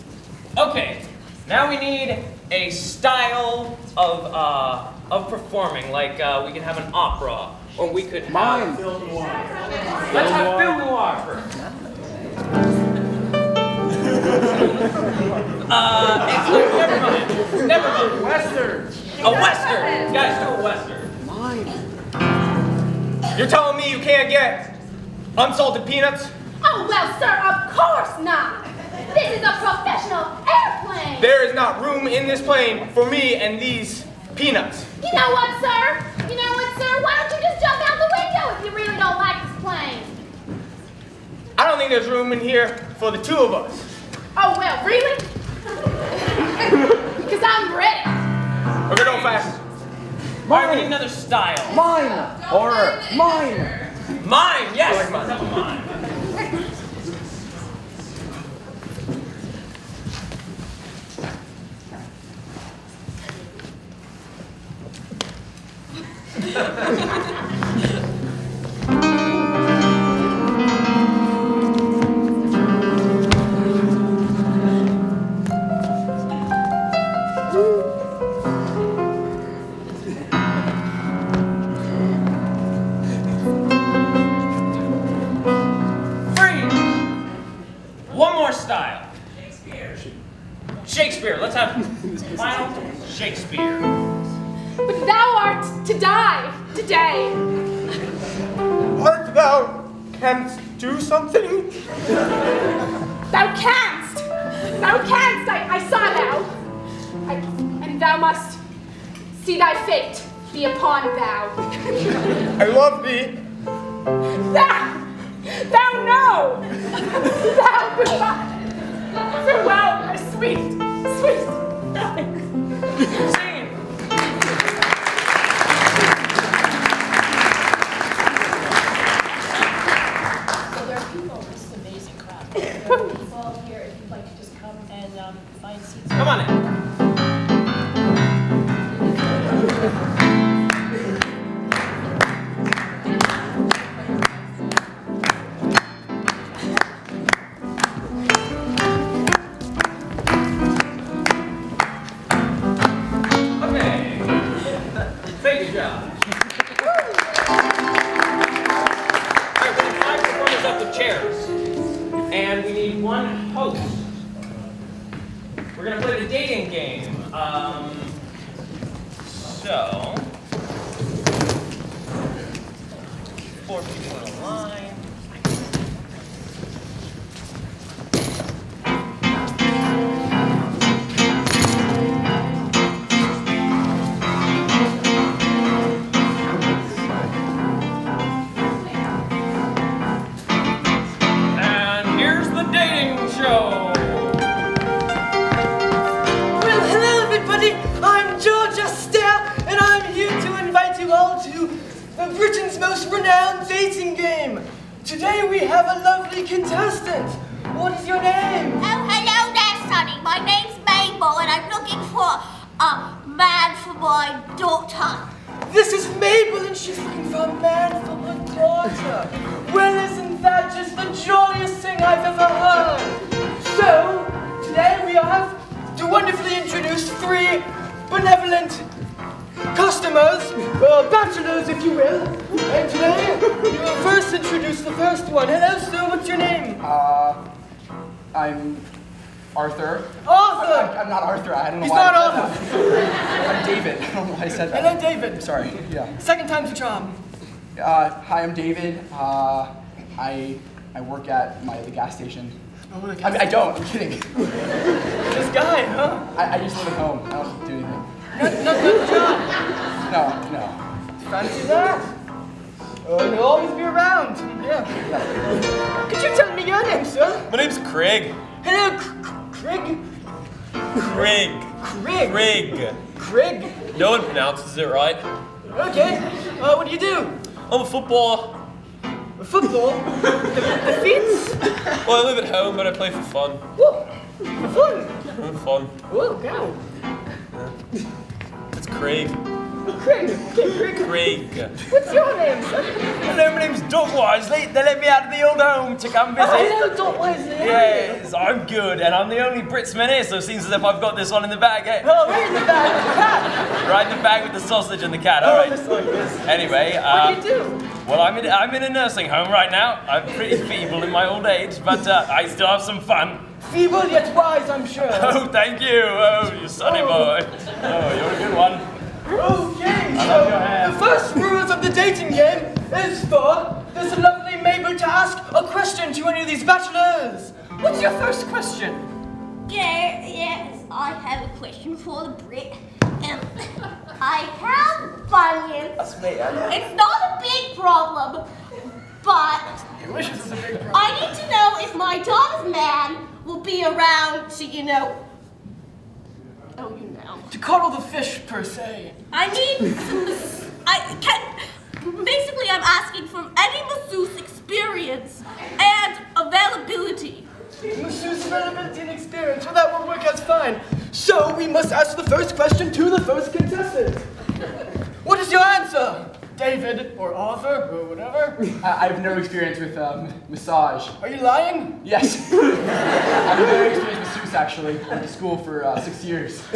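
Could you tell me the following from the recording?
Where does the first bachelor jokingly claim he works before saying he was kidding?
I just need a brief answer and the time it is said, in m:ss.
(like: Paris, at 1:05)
The gas station, at 4:11.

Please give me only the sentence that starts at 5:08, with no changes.
Well, I'm in, I'm in a nursing home right now.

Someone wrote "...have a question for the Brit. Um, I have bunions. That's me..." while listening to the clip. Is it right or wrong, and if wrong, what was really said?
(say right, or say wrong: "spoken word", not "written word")
right.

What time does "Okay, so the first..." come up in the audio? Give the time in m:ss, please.
5:19.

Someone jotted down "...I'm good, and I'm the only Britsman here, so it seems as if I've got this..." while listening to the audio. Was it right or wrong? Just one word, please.
right.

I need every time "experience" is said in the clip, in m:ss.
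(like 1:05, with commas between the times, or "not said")
5:54, 5:59, 6:09, 6:13.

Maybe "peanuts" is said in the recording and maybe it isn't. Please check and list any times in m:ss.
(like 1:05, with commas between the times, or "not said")
0:25, 0:34.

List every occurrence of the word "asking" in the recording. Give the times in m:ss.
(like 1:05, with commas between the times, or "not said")
5:52.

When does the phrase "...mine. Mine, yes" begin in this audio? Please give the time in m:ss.
0:53.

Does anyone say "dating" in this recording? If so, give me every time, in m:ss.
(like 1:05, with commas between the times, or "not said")
3:23, 5:21.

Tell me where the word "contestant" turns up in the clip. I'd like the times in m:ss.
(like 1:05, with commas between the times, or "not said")
3:26, 6:03.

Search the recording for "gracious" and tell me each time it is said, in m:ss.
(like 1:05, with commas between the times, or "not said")
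not said.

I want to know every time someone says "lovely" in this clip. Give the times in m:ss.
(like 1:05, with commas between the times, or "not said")
3:26, 5:24.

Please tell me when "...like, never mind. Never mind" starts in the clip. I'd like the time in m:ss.
0:16.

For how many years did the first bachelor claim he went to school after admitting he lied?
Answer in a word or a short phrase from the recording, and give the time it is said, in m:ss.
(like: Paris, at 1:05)
6, at 6:16.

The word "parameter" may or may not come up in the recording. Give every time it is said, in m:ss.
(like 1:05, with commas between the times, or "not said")
not said.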